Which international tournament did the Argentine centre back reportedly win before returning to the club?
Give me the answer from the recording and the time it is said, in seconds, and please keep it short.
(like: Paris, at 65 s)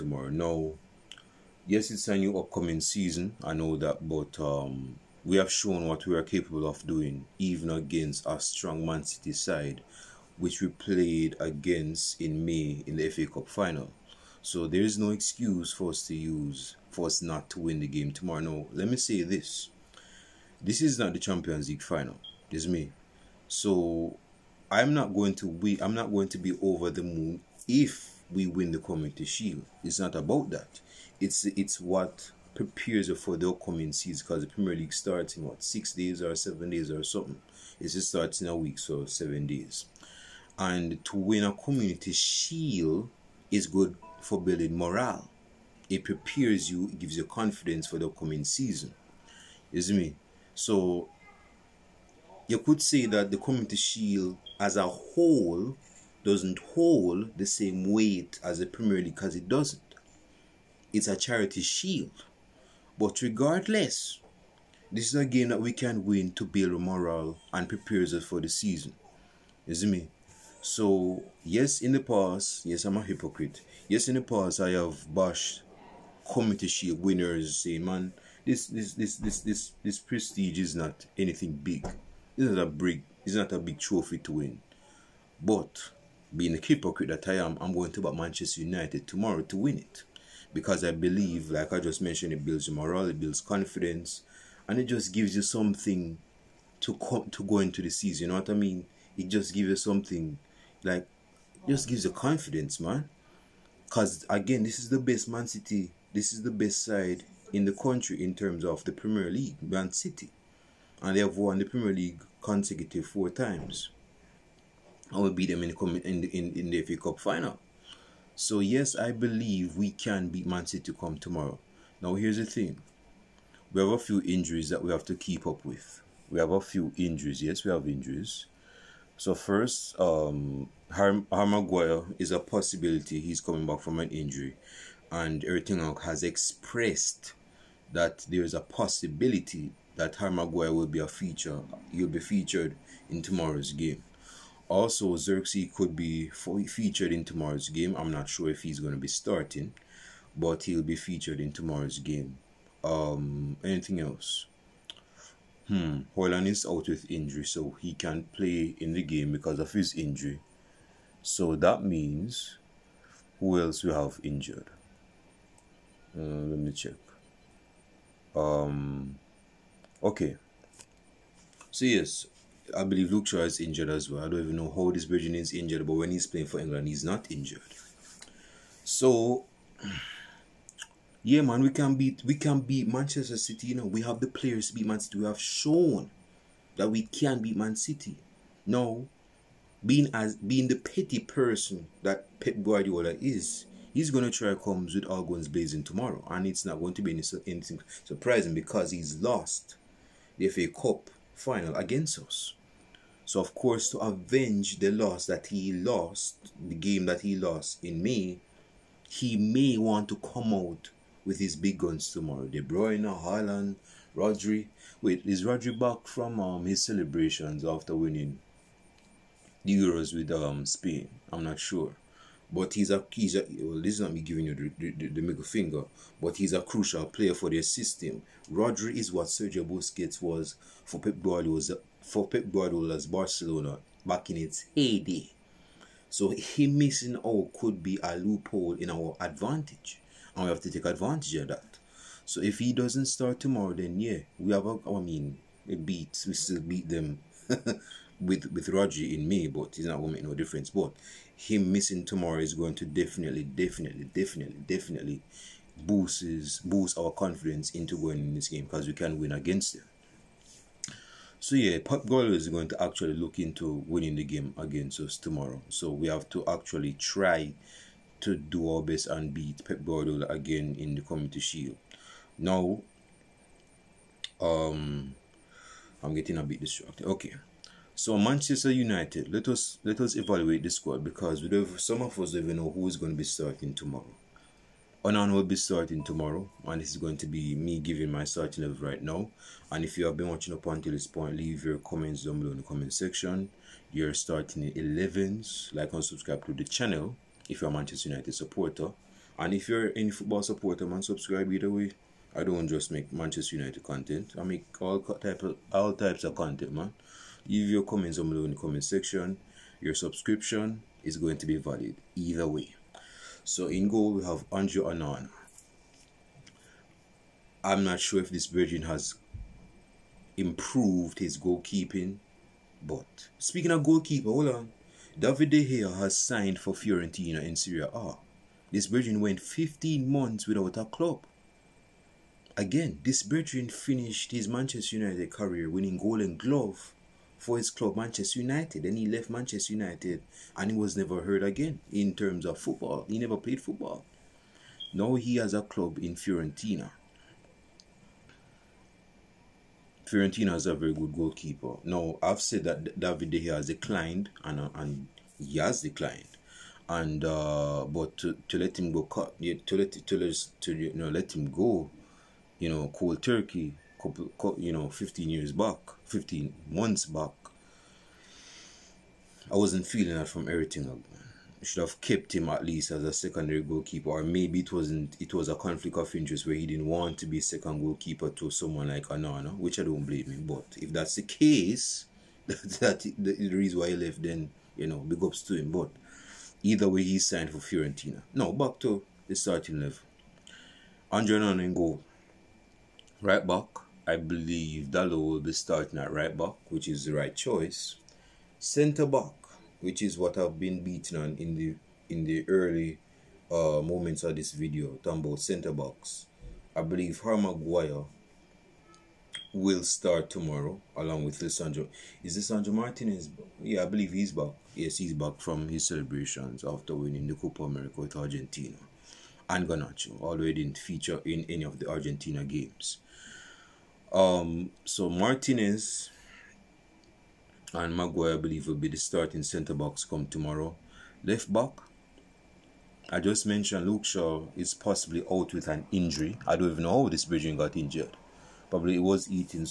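Copa America, at 417 s.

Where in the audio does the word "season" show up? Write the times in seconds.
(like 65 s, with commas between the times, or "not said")
2 s, 33 s, 48 s, 68 s, 97 s.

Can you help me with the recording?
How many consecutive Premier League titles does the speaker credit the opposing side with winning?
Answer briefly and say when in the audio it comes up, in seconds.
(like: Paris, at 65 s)
4, at 113 s.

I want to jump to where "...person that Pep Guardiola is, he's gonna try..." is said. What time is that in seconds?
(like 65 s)
191 s.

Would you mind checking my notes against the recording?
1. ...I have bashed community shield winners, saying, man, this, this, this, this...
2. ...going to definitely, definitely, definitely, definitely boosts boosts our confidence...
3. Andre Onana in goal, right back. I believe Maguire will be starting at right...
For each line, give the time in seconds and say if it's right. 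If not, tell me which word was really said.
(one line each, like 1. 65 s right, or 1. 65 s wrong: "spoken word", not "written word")
1. 74 s right
2. 252 s right
3. 391 s wrong: "Dalot", not "Maguire".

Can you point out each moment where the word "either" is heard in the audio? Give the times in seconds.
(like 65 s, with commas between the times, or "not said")
301 s, 312 s, 386 s.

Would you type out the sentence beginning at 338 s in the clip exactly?
Then he left Manchester United and he was never heard again in terms of football.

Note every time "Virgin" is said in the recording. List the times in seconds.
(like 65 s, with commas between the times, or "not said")
175 s, 318 s, 328 s, 333 s.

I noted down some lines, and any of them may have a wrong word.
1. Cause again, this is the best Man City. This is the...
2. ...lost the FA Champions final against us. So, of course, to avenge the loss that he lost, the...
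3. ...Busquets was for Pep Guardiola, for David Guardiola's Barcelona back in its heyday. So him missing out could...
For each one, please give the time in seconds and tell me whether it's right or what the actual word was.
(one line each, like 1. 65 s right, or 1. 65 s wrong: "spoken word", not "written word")
1. 103 s right
2. 199 s wrong: "Cup", not "Champions"
3. 229 s wrong: "Pep", not "David".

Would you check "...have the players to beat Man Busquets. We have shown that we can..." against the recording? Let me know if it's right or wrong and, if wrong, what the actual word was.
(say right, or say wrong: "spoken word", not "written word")
wrong: "City", not "Busquets".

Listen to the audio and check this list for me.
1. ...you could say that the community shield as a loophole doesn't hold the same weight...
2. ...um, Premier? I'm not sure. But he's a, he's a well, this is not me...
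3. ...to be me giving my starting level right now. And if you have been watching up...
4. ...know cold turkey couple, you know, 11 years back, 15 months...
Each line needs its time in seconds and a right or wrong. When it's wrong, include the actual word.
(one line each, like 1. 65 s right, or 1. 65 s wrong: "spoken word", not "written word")
1. 52 s wrong: "whole", not "loophole"
2. 220 s wrong: "Spain", not "Premier"
3. 287 s right
4. 362 s wrong: "15", not "11".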